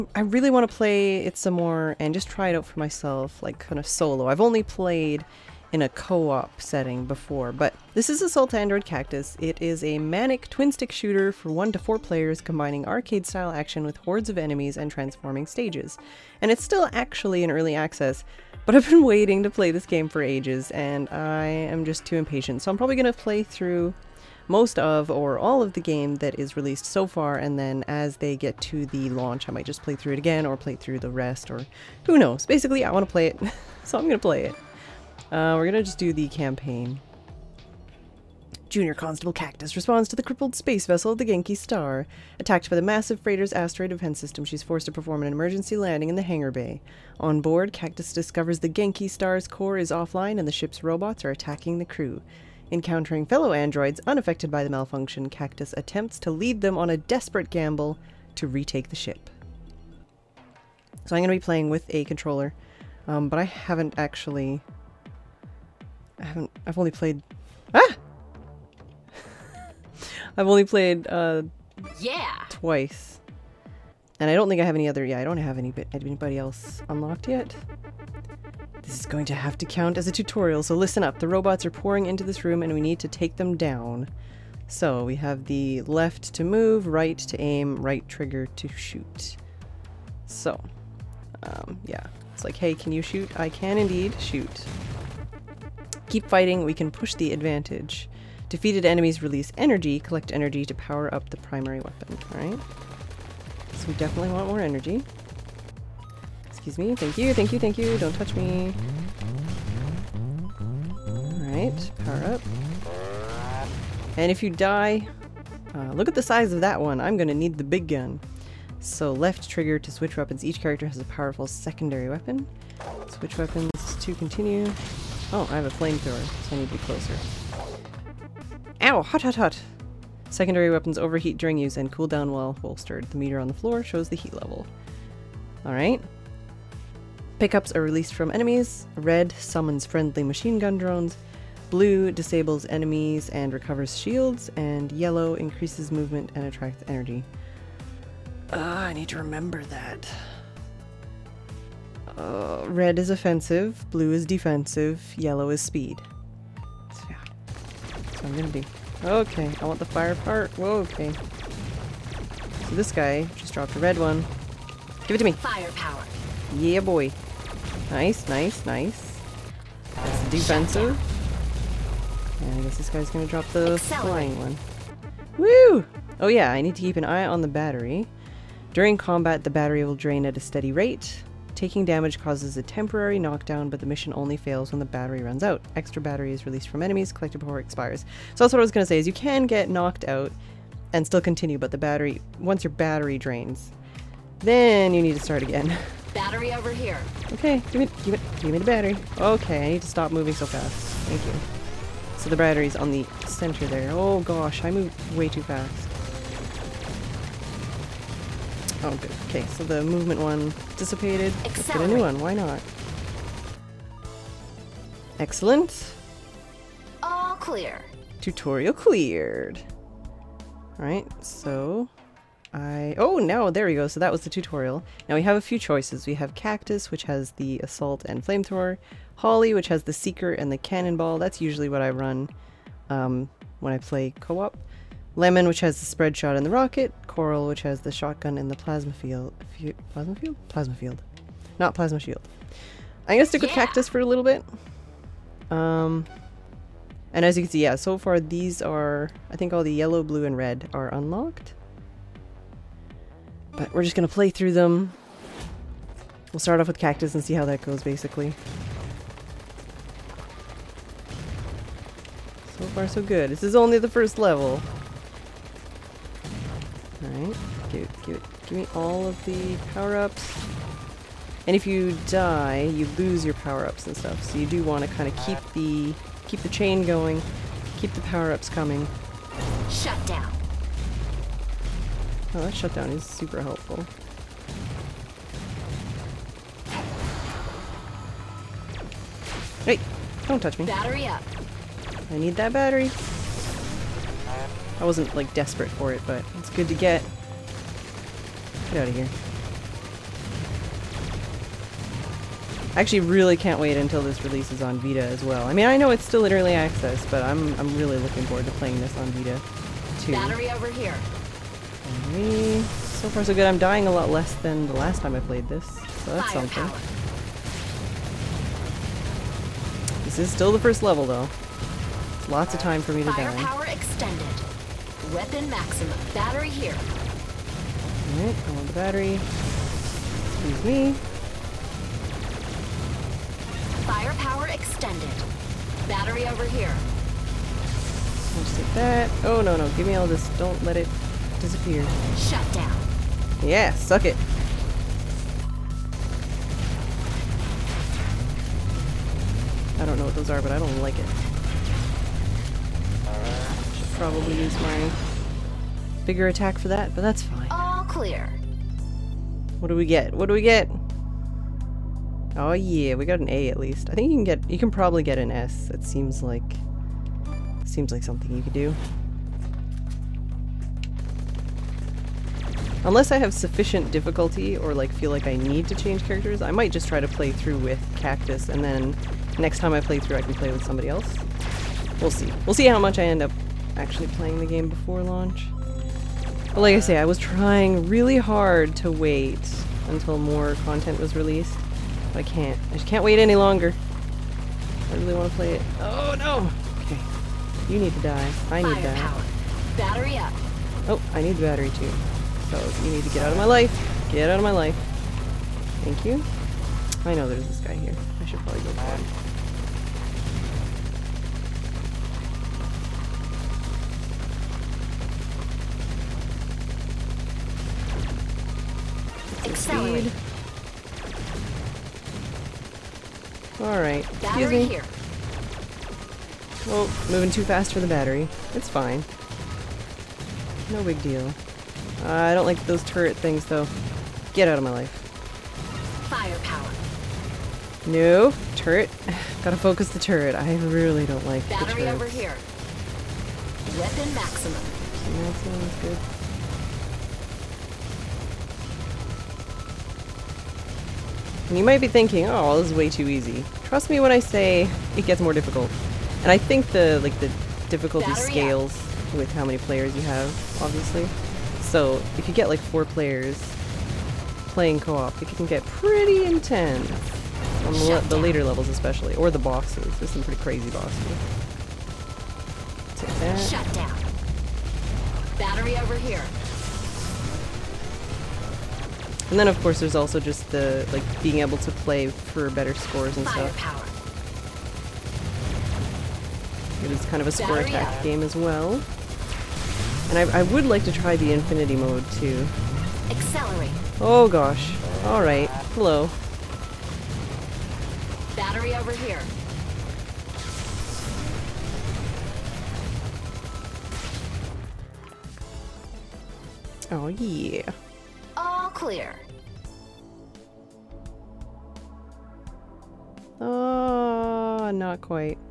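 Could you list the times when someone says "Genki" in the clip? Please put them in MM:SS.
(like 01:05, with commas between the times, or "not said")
00:41, 00:48.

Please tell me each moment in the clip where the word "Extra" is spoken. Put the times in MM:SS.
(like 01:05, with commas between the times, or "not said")
03:05.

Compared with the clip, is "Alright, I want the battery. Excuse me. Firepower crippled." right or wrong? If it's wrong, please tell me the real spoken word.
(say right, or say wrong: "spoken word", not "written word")
wrong: "extended", not "crippled".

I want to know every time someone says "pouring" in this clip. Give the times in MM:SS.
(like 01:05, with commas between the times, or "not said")
01:21.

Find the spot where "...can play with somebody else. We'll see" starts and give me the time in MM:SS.
06:20.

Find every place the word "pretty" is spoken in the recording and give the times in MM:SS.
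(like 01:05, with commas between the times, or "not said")
07:45, 07:50.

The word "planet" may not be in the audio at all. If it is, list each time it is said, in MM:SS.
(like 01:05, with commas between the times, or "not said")
not said.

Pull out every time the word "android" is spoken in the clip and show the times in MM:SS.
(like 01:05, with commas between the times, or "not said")
00:08, 00:53.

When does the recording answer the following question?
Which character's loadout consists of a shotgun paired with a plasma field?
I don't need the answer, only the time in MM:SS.
03:57.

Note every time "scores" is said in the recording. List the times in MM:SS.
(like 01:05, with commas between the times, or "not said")
08:02, 08:07.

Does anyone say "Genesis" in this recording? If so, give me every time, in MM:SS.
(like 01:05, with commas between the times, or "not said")
not said.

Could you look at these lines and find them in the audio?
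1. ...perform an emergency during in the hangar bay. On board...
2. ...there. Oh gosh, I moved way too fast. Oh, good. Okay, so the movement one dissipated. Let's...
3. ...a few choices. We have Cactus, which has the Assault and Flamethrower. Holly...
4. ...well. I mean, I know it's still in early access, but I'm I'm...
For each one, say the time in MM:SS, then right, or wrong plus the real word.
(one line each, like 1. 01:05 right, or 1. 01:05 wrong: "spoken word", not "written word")
1. 00:44 wrong: "landing", not "during"
2. 03:23 right
3. 03:45 right
4. 05:05 right.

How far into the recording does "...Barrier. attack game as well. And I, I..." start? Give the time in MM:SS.
08:07.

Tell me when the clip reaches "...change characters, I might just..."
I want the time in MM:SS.
06:15.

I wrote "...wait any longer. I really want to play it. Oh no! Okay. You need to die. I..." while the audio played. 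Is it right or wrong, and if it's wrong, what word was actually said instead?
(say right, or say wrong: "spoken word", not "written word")
right.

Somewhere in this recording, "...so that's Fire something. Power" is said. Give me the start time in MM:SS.
05:15.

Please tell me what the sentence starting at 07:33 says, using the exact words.
Trust me when I say it gets more difficult.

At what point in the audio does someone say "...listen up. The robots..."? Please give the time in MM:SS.
01:20.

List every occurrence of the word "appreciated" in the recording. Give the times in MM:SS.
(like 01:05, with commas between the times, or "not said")
not said.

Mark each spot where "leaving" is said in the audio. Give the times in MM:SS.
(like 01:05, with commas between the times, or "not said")
not said.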